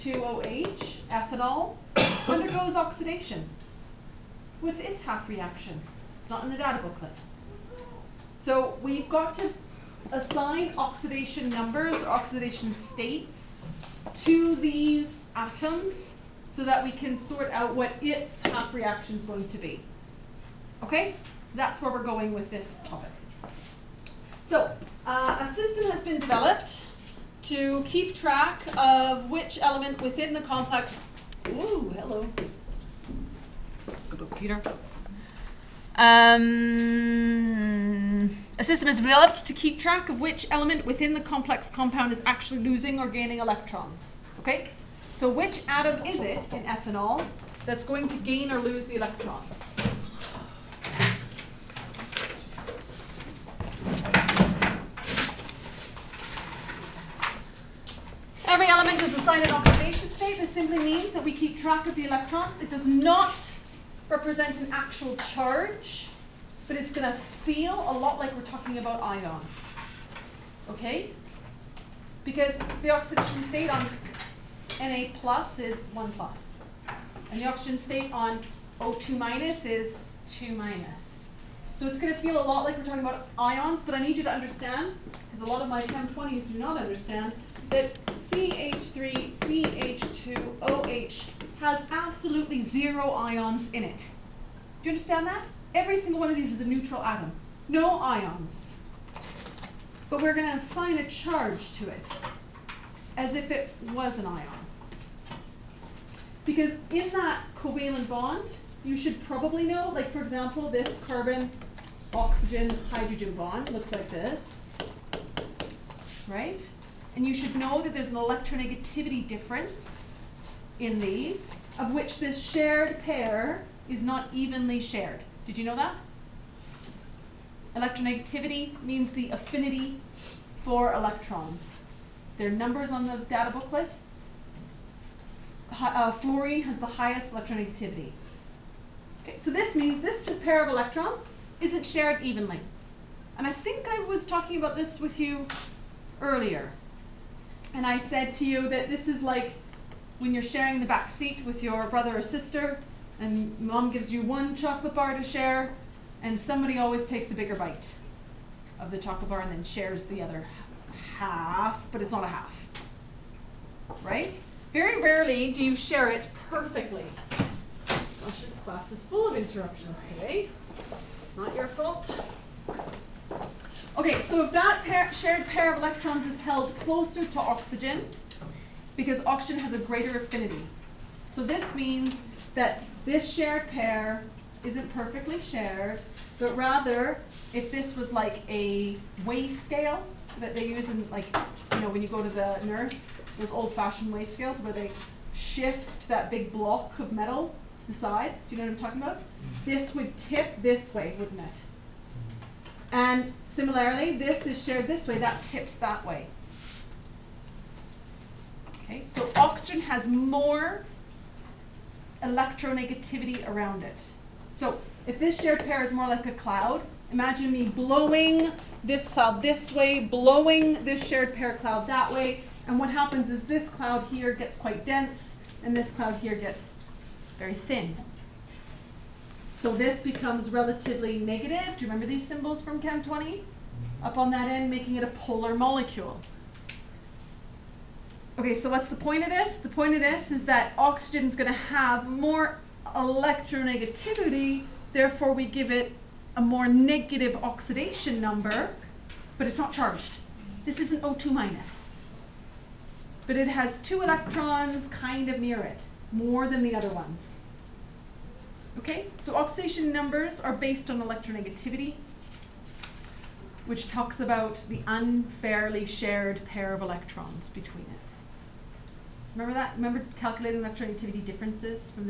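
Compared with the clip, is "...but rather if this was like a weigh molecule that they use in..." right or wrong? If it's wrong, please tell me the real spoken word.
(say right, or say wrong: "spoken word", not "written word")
wrong: "scale", not "molecule".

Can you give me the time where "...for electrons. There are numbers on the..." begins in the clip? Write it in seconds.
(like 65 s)
130 s.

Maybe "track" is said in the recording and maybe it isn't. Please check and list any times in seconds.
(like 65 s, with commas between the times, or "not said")
28 s, 39 s, 61 s.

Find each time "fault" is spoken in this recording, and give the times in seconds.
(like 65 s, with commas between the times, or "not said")
171 s.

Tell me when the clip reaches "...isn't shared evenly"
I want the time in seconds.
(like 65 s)
141 s.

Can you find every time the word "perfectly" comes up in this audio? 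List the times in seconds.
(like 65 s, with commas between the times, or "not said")
166 s, 184 s.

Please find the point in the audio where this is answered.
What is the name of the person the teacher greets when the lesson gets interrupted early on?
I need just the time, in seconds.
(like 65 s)
34 s.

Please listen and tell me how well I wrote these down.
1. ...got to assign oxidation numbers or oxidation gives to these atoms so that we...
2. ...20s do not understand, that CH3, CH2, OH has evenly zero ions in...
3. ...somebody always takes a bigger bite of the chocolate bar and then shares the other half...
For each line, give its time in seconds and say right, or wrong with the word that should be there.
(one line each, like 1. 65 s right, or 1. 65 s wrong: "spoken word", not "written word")
1. 9 s wrong: "states", not "gives"
2. 86 s wrong: "absolutely", not "evenly"
3. 156 s right.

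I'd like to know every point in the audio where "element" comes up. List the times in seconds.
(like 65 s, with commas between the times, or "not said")
29 s, 40 s, 58 s.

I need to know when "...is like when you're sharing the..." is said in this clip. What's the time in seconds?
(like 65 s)
149 s.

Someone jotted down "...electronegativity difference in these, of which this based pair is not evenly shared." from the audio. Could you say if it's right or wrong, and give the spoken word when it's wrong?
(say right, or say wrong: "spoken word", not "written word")
wrong: "shared", not "based".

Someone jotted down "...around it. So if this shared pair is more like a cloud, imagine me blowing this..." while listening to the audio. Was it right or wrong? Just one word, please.
right.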